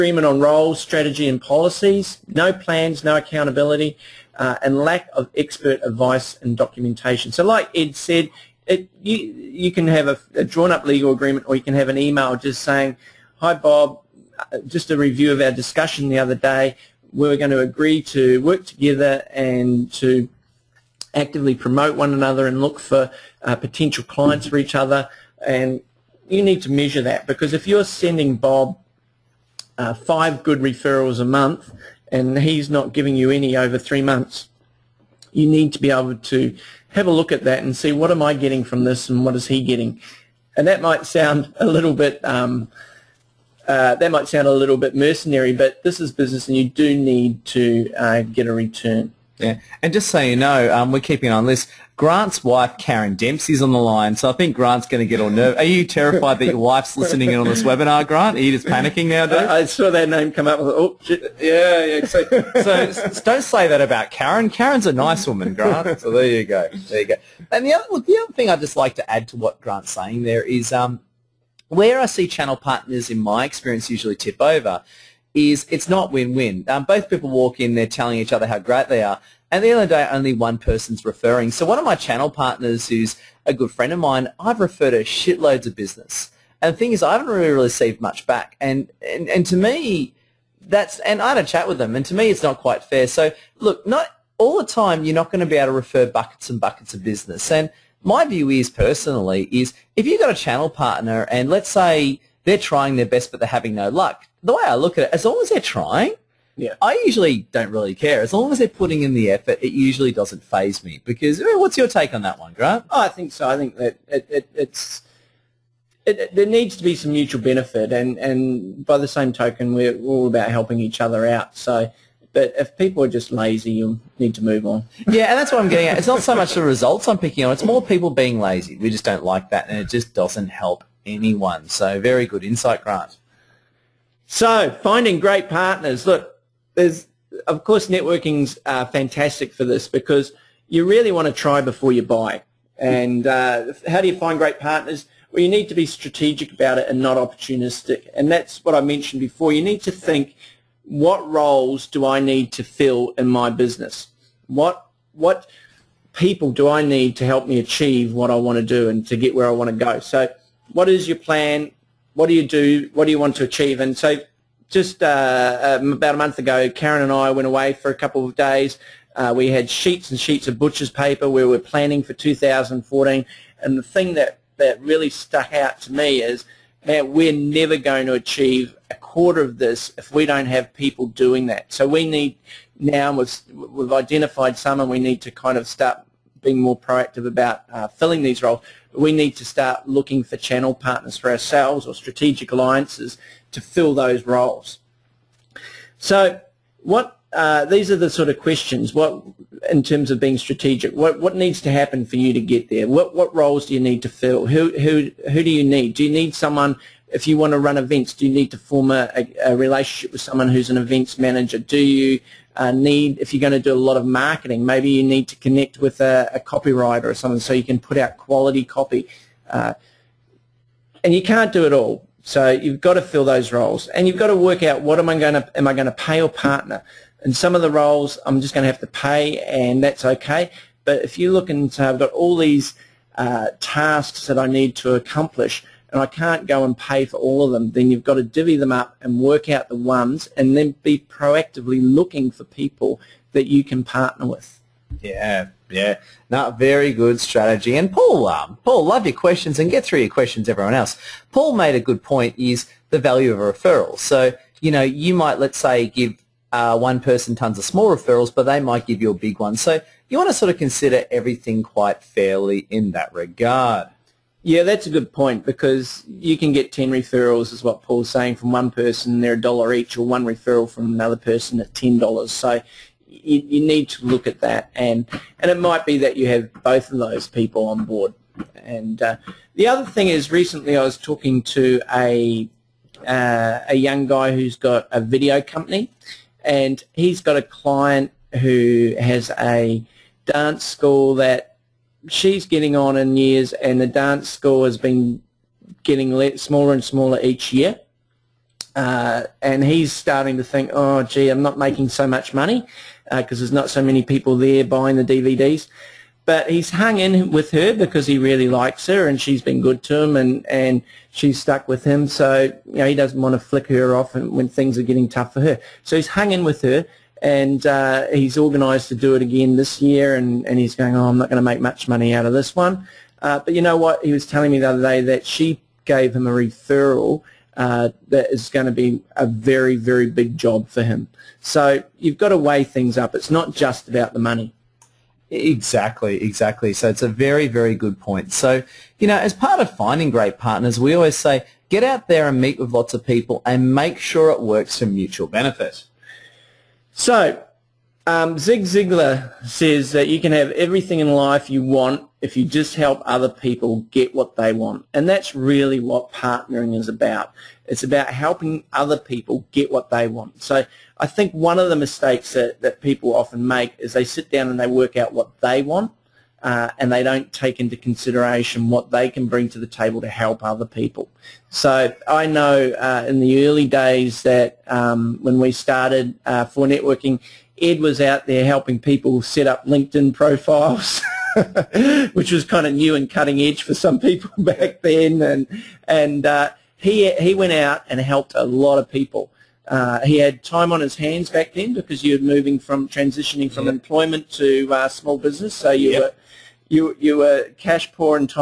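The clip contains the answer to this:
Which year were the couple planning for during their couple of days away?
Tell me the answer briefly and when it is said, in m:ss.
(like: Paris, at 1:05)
2014, at 2:52.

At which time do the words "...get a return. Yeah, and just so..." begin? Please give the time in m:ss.
0:48.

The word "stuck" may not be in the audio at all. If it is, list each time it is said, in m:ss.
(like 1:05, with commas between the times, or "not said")
2:55, 5:11.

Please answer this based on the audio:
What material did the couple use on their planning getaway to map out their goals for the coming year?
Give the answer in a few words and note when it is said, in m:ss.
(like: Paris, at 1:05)
butcher's paper, at 2:50.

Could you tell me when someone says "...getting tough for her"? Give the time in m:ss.
5:14.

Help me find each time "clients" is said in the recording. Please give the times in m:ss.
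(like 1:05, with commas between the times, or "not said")
0:24, 4:47.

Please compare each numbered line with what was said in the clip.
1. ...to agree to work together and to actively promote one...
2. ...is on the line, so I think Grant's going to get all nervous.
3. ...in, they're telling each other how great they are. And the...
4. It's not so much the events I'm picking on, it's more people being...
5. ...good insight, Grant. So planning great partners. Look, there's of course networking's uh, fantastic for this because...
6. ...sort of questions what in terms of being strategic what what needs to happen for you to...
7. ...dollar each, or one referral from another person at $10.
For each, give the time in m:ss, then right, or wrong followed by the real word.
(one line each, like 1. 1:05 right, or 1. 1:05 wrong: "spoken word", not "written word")
1. 0:17 right
2. 0:53 right
3. 1:17 right
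4. 2:05 wrong: "results", not "events"
5. 2:12 wrong: "finding", not "planning"
6. 3:18 right
7. 4:29 right.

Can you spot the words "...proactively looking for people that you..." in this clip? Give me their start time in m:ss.
4:01.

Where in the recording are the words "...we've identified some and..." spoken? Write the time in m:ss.
3:03.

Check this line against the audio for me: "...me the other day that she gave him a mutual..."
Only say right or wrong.
wrong.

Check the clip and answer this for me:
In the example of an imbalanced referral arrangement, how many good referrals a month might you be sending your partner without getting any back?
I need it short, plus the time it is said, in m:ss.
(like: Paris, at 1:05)
5, at 0:29.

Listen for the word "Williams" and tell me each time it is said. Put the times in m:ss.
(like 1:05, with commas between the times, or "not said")
not said.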